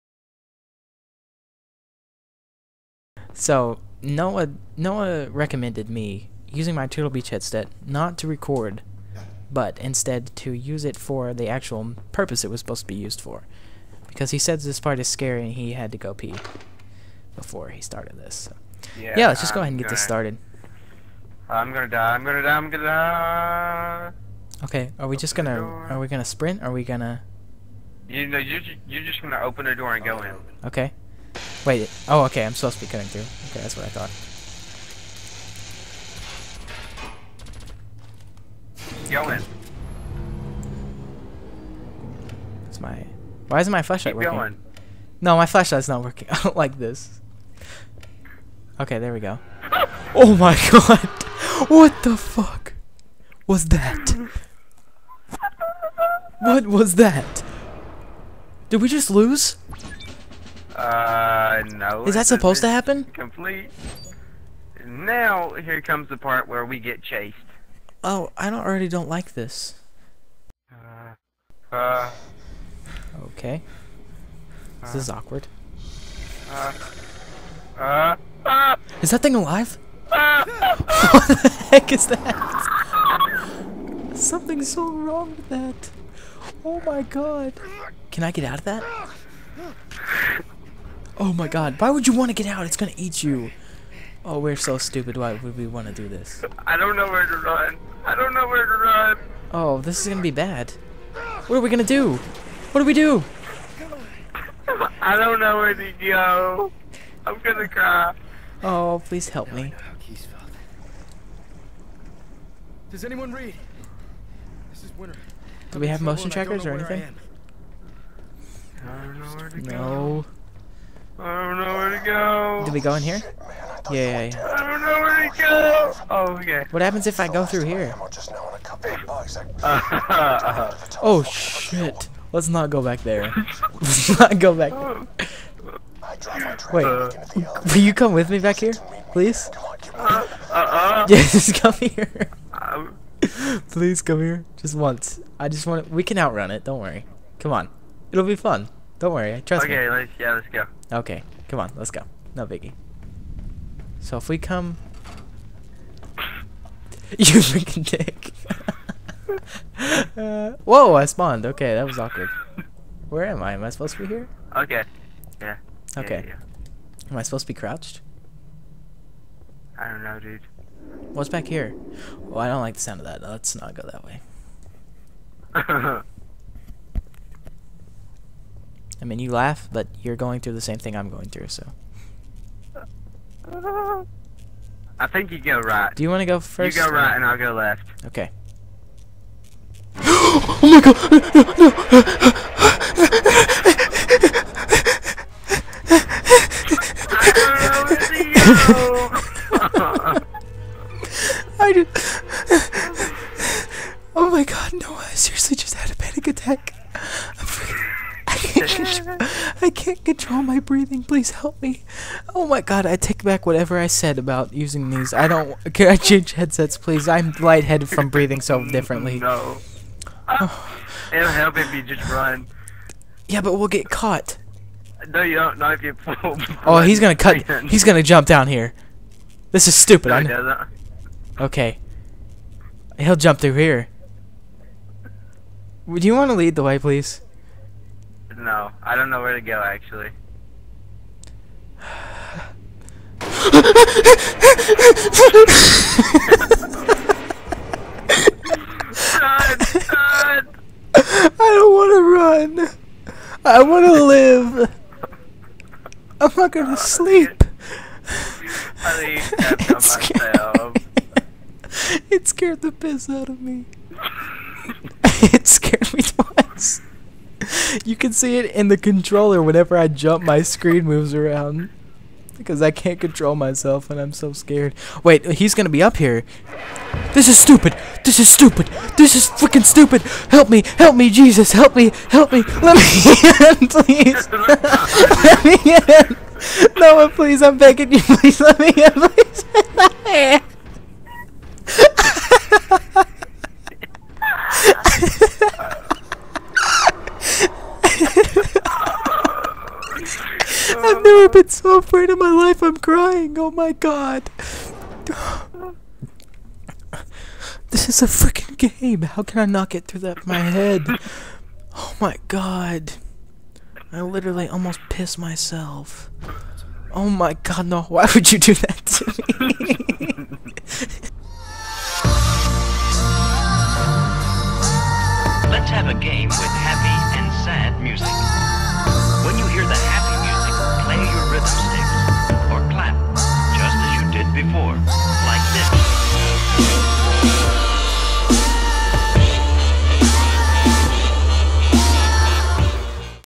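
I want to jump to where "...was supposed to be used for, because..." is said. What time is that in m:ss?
0:12.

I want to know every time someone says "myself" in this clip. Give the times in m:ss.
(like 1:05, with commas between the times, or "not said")
4:33, 5:15.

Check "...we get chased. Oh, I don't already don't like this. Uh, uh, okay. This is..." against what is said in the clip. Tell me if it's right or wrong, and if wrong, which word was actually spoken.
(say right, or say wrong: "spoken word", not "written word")
right.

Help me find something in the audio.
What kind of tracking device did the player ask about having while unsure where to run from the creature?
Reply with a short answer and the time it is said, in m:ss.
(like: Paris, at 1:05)
motion trackers, at 1:56.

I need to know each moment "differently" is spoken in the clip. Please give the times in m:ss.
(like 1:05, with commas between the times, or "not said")
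3:38.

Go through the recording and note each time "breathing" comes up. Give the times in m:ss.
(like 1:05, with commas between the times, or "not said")
3:30, 3:38.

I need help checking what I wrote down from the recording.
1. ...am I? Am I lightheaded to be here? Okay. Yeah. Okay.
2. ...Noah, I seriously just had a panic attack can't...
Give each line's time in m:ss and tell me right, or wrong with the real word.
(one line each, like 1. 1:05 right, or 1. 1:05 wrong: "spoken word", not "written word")
1. 2:43 wrong: "supposed", not "lightheaded"
2. 3:24 right.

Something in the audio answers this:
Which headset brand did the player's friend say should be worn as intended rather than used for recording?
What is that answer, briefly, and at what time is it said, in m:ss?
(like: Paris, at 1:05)
Turtle Beach, at 0:06.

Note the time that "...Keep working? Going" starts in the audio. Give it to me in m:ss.
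0:44.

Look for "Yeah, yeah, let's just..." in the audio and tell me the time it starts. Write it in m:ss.
0:18.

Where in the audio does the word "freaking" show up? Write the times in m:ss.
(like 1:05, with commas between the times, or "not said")
2:37, 4:39, 5:08.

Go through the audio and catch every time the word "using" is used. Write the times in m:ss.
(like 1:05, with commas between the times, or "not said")
0:06, 3:34.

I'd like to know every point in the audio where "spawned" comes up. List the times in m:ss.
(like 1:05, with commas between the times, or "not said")
2:41.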